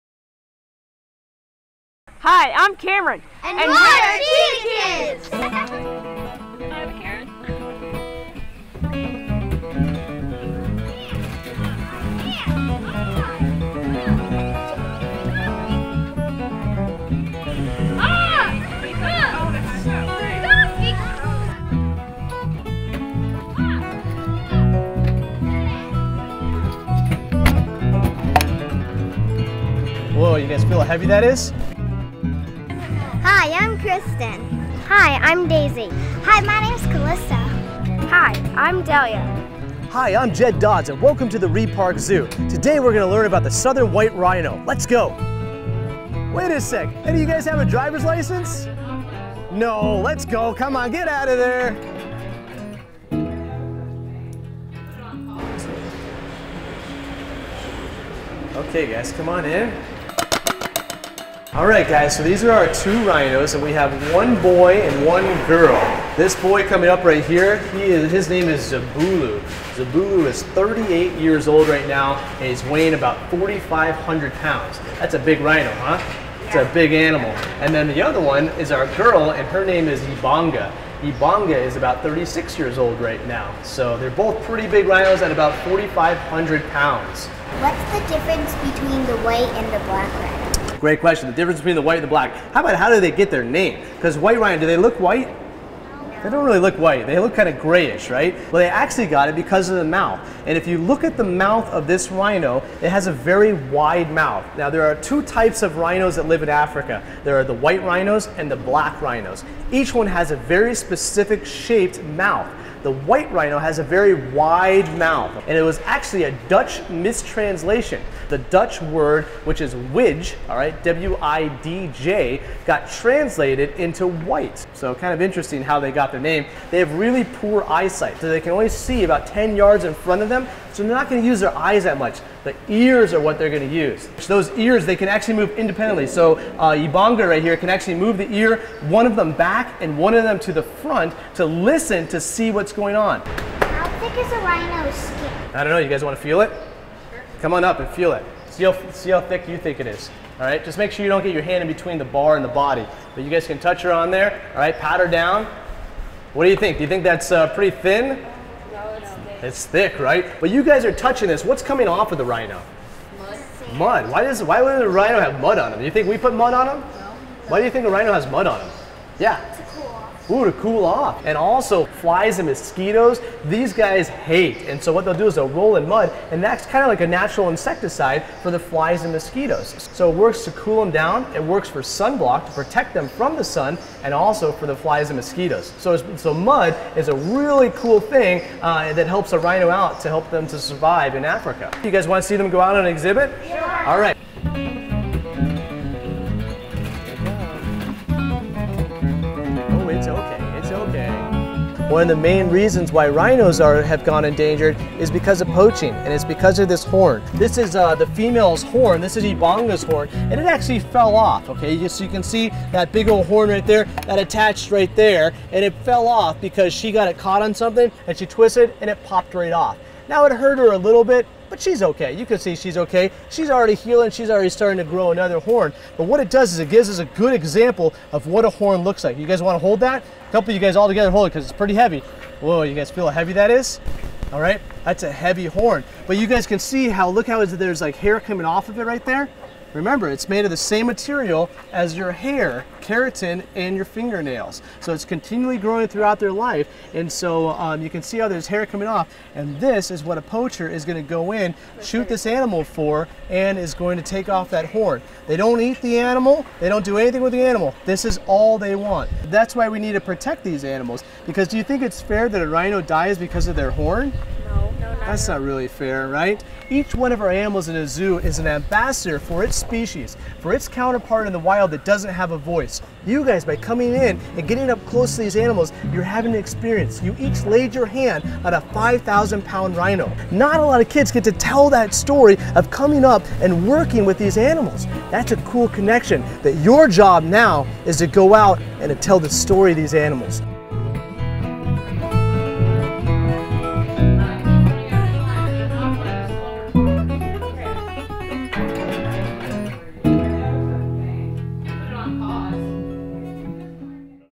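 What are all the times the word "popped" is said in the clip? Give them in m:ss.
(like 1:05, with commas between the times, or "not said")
3:39.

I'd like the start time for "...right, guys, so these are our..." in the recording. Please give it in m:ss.
1:01.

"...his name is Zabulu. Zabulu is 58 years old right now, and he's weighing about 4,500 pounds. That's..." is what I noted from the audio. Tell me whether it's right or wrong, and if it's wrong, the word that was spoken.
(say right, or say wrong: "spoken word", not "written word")
wrong: "38", not "58".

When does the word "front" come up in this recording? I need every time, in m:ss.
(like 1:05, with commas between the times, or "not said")
2:09, 2:20.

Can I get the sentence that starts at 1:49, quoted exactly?
Each one has a very specific shaped mouth.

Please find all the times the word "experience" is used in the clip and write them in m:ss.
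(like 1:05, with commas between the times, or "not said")
4:36.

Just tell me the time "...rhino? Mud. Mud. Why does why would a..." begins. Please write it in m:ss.
2:42.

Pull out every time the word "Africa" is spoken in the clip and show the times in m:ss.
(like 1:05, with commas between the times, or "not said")
1:46, 3:11.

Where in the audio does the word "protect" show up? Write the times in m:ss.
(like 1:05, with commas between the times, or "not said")
3:02, 4:20.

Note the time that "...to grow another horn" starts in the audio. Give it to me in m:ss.
3:44.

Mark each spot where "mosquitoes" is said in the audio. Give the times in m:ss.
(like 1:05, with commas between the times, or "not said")
2:52, 2:59, 3:05.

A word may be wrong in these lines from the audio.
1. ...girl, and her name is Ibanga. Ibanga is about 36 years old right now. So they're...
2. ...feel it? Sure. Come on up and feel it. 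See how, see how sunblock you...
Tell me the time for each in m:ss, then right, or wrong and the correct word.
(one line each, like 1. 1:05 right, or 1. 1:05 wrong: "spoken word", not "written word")
1. 1:18 right
2. 2:26 wrong: "thick", not "sunblock".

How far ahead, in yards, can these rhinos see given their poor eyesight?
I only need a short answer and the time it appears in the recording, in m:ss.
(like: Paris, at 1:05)
10 yards, at 2:09.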